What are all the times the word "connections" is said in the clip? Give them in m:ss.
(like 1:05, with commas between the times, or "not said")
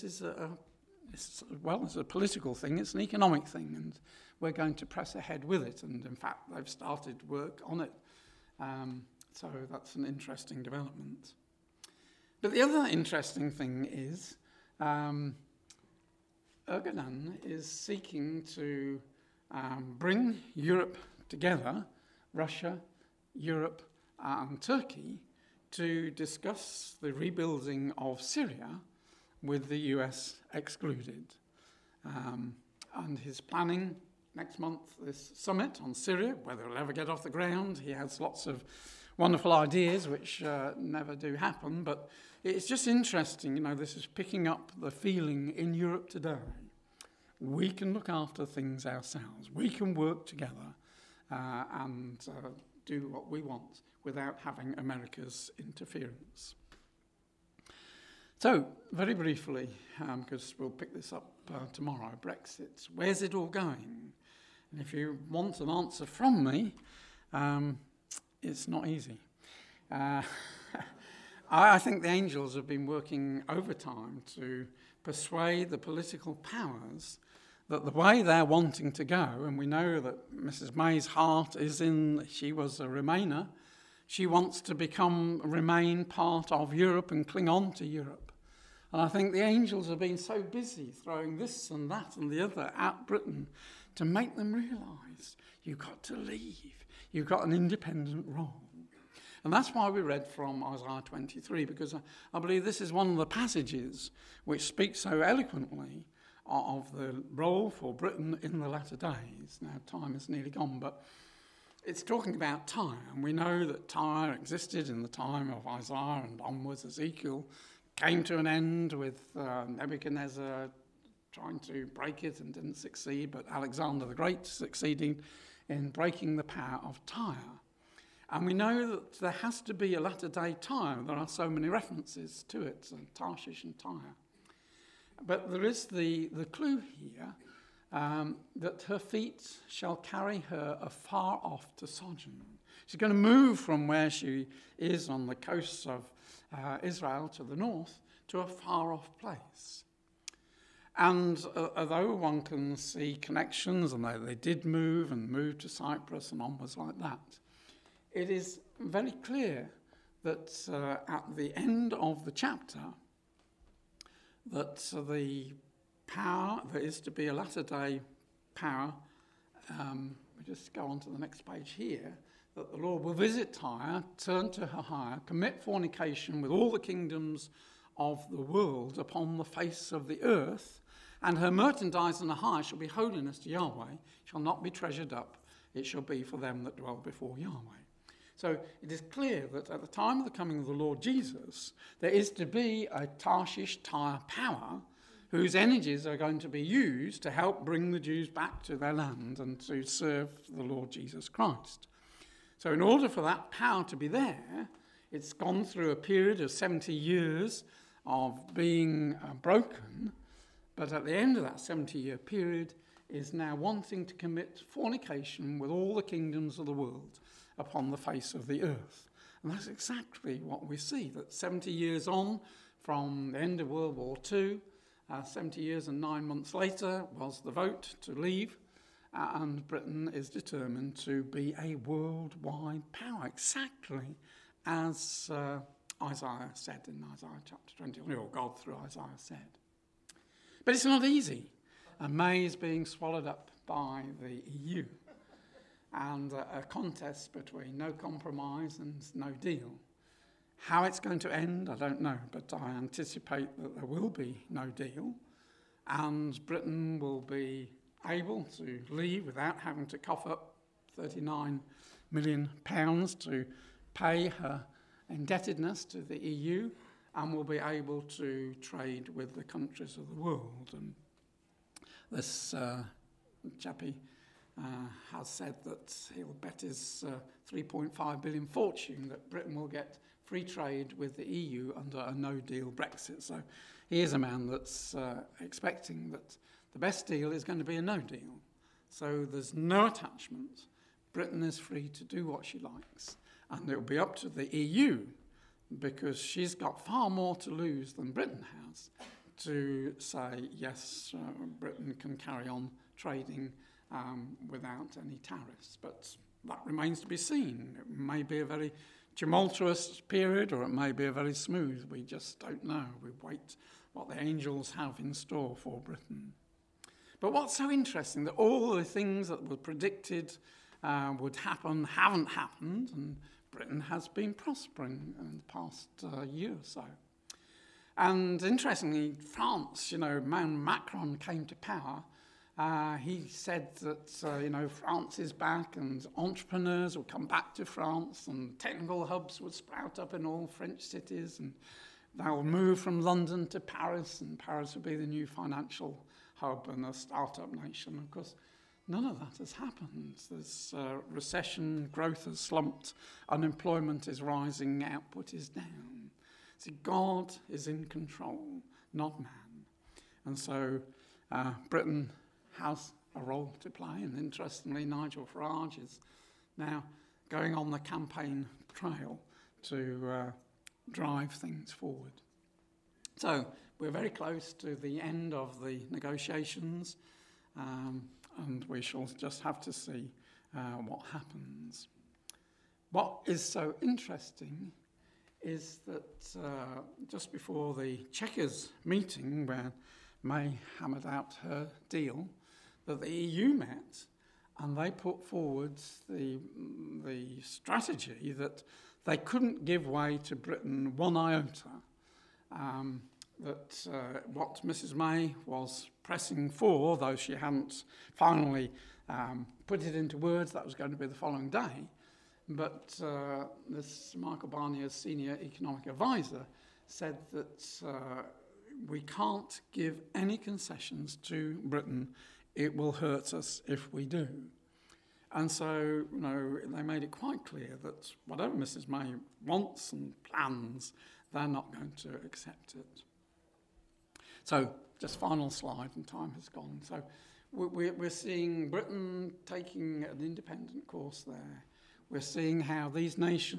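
2:33.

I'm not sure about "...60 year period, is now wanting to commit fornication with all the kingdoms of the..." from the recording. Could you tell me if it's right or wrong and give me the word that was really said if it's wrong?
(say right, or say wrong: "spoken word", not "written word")
wrong: "70", not "60".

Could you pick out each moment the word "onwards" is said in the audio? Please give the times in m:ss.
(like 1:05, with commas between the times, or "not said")
1:56, 2:36.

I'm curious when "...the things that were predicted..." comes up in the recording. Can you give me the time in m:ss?
5:18.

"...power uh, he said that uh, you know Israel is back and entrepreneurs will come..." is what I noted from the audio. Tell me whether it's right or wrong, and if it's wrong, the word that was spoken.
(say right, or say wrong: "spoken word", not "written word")
wrong: "France", not "Israel".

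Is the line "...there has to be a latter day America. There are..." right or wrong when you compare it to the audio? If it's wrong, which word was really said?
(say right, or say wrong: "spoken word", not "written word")
wrong: "Tyre", not "America".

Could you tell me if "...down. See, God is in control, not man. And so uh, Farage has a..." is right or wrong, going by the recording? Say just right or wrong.
wrong.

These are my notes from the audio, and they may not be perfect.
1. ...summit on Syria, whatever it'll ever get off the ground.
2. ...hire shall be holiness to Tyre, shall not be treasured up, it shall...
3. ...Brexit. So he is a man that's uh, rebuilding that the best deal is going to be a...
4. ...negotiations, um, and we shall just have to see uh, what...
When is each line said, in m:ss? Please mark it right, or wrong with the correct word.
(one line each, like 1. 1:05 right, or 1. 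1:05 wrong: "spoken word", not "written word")
1. 0:35 wrong: "whether", not "whatever"
2. 3:02 wrong: "Yahweh", not "Tyre"
3. 4:42 wrong: "expecting", not "rebuilding"
4. 6:15 right.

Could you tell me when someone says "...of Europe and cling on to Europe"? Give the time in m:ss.
1:26.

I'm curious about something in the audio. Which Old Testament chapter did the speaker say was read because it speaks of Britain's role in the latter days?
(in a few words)
Isaiah 23.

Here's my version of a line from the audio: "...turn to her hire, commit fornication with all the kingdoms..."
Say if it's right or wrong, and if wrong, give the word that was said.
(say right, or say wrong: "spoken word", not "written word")
right.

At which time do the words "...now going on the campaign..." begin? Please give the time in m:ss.
6:06.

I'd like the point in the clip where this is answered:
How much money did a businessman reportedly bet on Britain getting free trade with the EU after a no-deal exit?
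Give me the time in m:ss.
4:37.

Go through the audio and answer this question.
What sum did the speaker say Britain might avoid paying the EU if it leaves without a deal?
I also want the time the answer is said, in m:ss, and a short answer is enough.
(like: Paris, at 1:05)
39 million pounds, at 4:20.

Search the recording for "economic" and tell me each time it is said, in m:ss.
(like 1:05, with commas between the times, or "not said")
0:03, 6:55.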